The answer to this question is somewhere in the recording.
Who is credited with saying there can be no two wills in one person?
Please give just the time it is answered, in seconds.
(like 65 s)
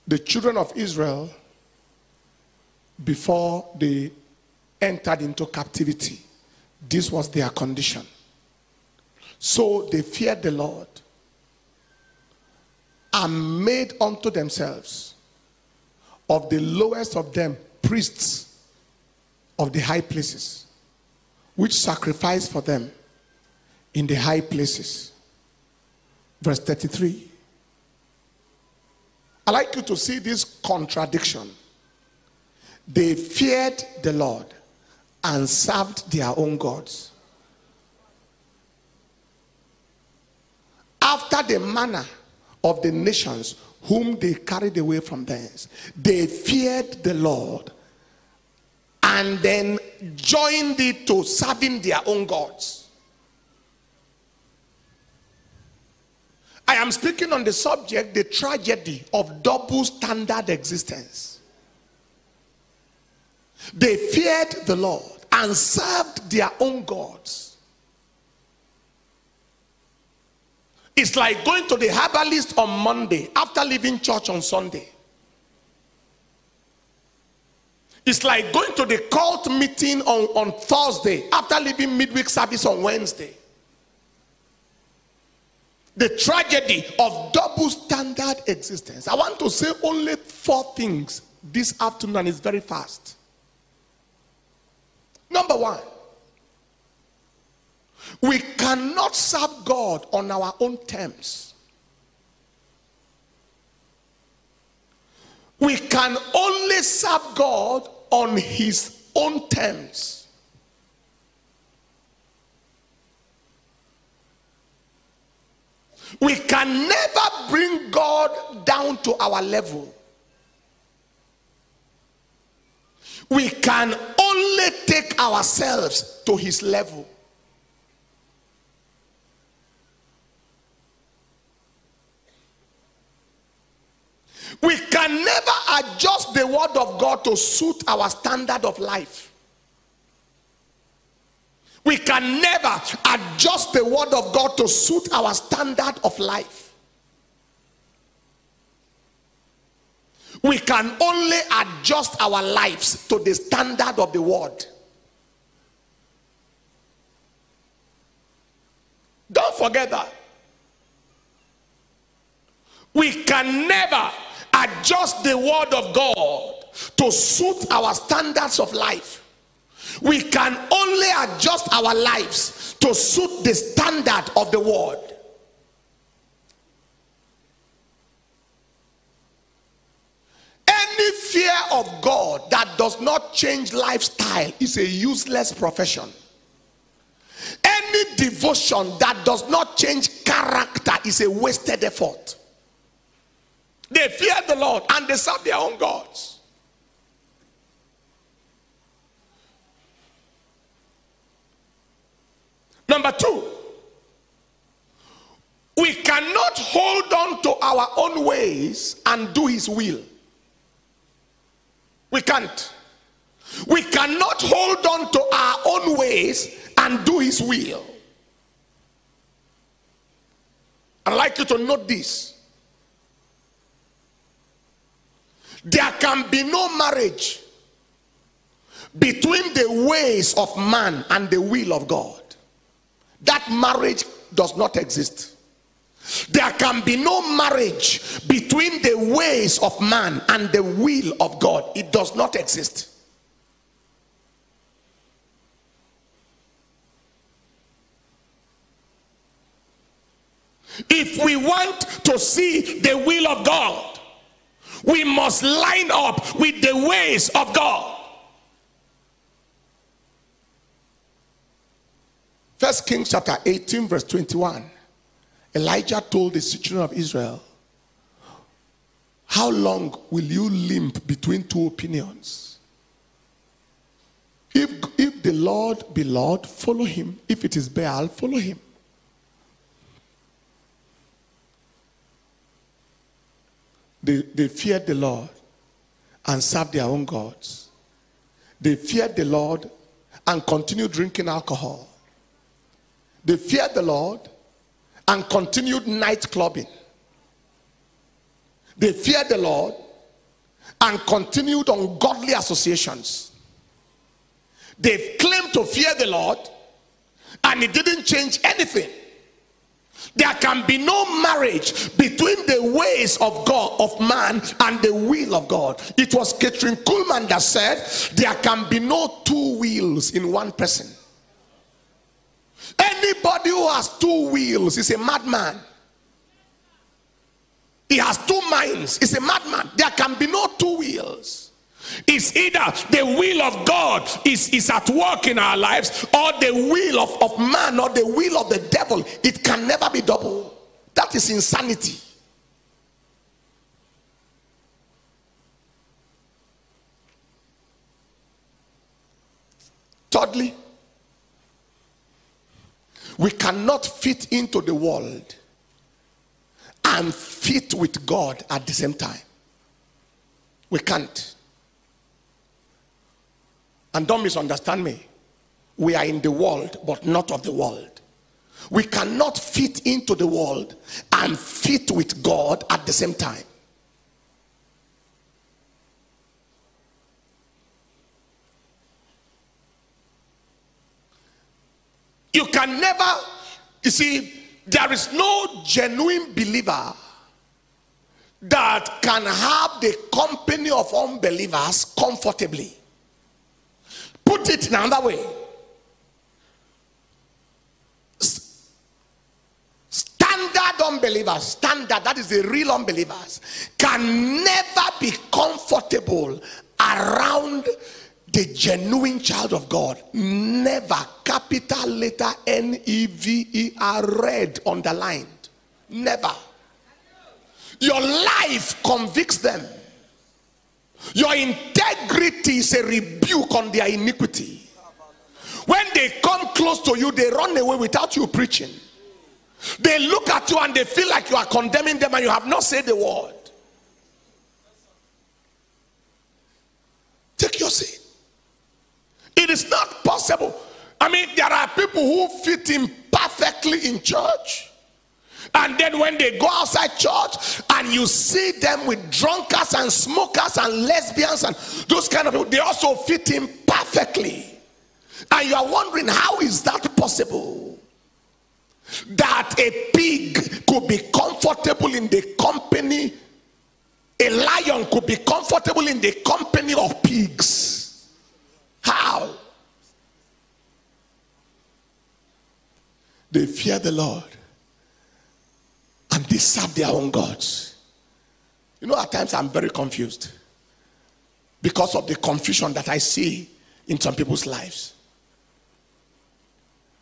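316 s.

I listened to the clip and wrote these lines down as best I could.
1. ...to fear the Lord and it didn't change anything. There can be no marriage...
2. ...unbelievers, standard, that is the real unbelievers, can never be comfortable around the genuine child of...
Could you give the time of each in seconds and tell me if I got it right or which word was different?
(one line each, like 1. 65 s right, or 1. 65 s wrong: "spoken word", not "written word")
1. 305 s right
2. 400 s right.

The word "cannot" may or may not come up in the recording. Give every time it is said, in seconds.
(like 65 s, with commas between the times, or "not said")
98 s, 205 s, 213 s, 353 s, 368 s.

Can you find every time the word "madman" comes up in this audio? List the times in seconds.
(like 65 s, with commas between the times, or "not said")
324 s, 329 s.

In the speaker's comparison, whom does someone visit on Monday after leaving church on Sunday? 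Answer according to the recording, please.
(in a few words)
The herbalist.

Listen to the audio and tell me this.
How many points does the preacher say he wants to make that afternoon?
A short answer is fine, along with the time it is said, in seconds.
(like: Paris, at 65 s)
4, at 90 s.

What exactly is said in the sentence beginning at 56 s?
I am speaking on the subject the tragedy of double standard existence.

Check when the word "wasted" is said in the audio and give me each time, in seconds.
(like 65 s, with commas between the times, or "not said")
191 s.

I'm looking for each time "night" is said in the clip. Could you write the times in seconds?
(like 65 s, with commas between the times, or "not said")
295 s.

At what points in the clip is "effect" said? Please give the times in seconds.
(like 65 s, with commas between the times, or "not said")
not said.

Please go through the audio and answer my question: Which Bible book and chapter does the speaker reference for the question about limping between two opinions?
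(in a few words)
First Kings 18.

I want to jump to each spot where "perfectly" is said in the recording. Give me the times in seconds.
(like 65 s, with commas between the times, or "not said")
443 s, 453 s.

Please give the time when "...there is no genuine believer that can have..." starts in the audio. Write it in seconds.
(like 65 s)
384 s.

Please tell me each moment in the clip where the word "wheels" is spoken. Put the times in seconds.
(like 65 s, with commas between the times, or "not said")
324 s, 330 s.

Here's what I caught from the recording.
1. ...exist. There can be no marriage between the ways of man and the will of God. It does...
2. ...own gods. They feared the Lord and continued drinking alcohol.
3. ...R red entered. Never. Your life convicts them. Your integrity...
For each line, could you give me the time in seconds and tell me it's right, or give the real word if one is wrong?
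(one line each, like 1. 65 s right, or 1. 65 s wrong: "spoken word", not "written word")
1. 234 s right
2. 286 s right
3. 413 s wrong: "underlined", not "entered".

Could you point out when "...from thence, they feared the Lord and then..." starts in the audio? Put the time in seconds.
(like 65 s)
45 s.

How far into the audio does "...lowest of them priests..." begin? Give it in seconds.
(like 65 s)
16 s.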